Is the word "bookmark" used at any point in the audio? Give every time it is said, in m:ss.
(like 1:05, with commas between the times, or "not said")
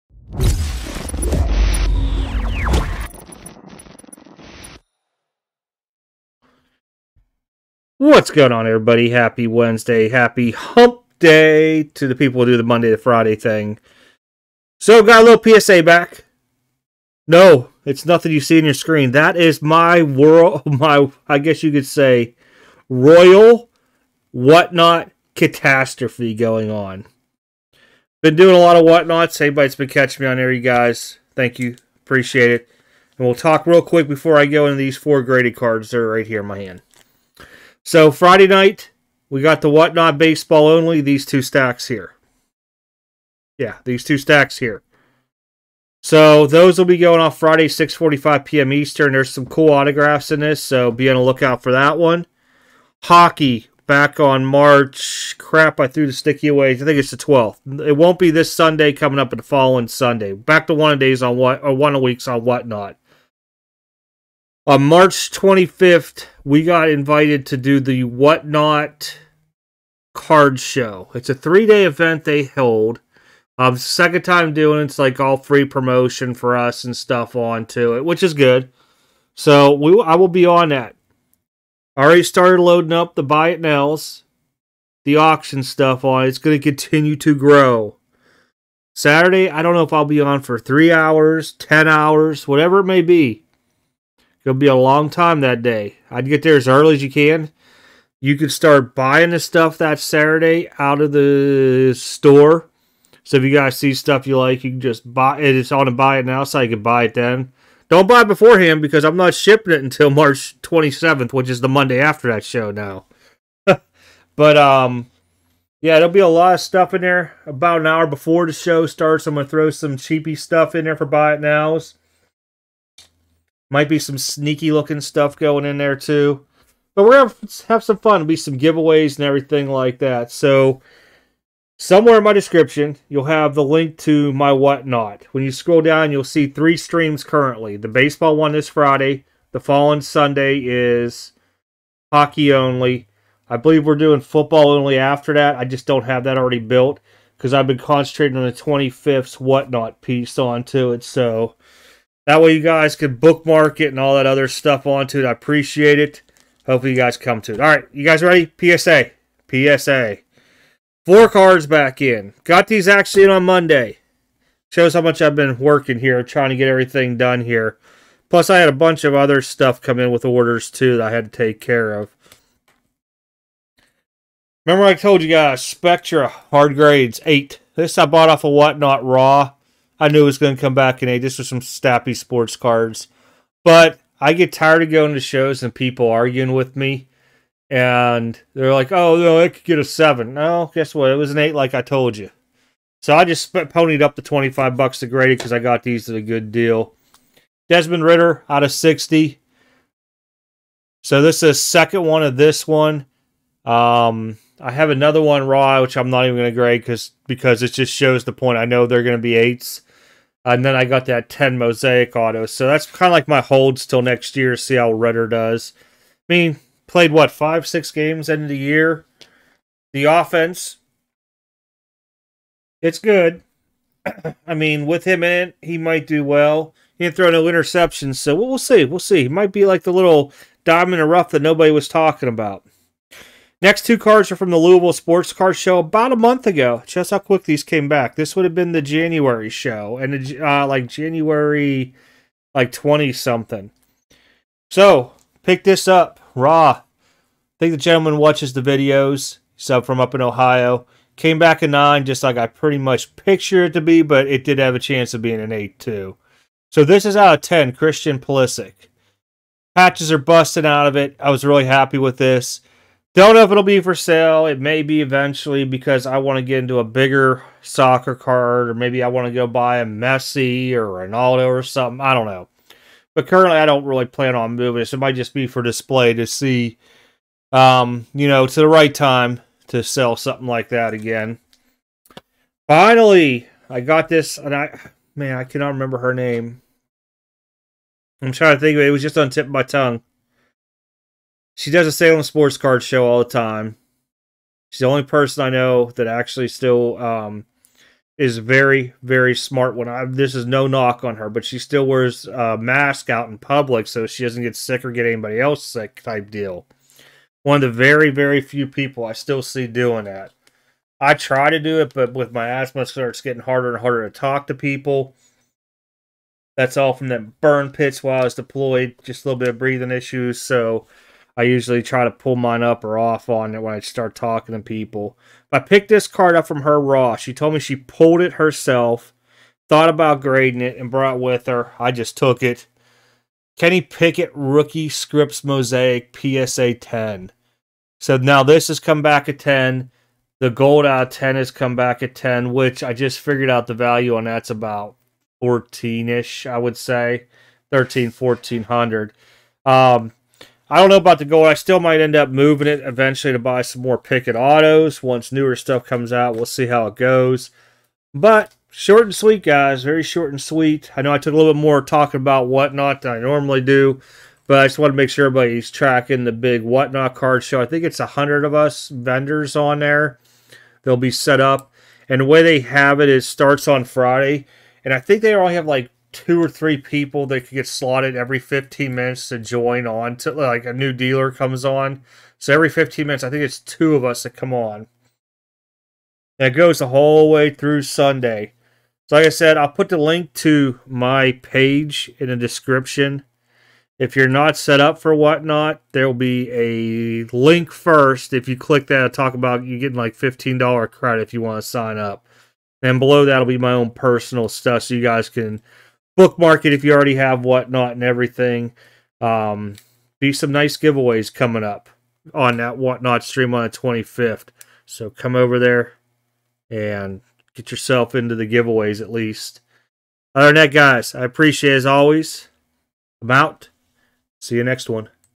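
2:33, 6:46.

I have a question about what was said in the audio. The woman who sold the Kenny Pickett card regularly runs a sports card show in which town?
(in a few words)
Salem.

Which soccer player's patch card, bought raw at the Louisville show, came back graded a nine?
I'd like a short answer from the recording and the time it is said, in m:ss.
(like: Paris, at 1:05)
Christian Pulisic, at 4:17.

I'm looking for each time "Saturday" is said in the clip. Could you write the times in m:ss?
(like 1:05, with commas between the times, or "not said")
1:28, 1:39.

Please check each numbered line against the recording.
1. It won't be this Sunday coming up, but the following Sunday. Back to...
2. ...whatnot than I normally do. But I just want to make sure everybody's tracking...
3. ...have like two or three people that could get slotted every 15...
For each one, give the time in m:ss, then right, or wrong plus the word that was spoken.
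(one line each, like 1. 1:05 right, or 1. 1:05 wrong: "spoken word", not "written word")
1. 0:57 right
2. 6:02 right
3. 6:15 right.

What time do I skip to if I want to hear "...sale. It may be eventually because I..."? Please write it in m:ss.
4:23.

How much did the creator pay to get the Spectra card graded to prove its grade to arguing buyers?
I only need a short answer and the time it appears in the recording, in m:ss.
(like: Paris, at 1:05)
$25, at 3:14.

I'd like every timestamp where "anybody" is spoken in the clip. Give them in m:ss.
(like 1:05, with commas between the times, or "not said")
0:29, 5:05.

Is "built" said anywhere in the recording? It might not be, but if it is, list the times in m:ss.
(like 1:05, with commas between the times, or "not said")
2:26.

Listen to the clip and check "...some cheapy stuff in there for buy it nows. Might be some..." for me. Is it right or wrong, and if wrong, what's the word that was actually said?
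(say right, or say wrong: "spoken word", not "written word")
right.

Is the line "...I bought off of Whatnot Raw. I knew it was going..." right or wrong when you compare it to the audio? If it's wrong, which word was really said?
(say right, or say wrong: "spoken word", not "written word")
right.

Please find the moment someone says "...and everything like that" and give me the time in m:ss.
2:09.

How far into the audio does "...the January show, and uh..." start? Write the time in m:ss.
3:58.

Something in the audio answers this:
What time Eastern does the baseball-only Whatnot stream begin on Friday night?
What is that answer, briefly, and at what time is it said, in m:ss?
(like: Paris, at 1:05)
6:45 p.m., at 0:47.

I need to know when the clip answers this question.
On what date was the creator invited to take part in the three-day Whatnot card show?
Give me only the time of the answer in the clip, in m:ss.
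1:04.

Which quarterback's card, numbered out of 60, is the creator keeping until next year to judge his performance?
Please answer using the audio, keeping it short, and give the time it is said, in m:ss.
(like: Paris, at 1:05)
Desmond Ridder, at 3:17.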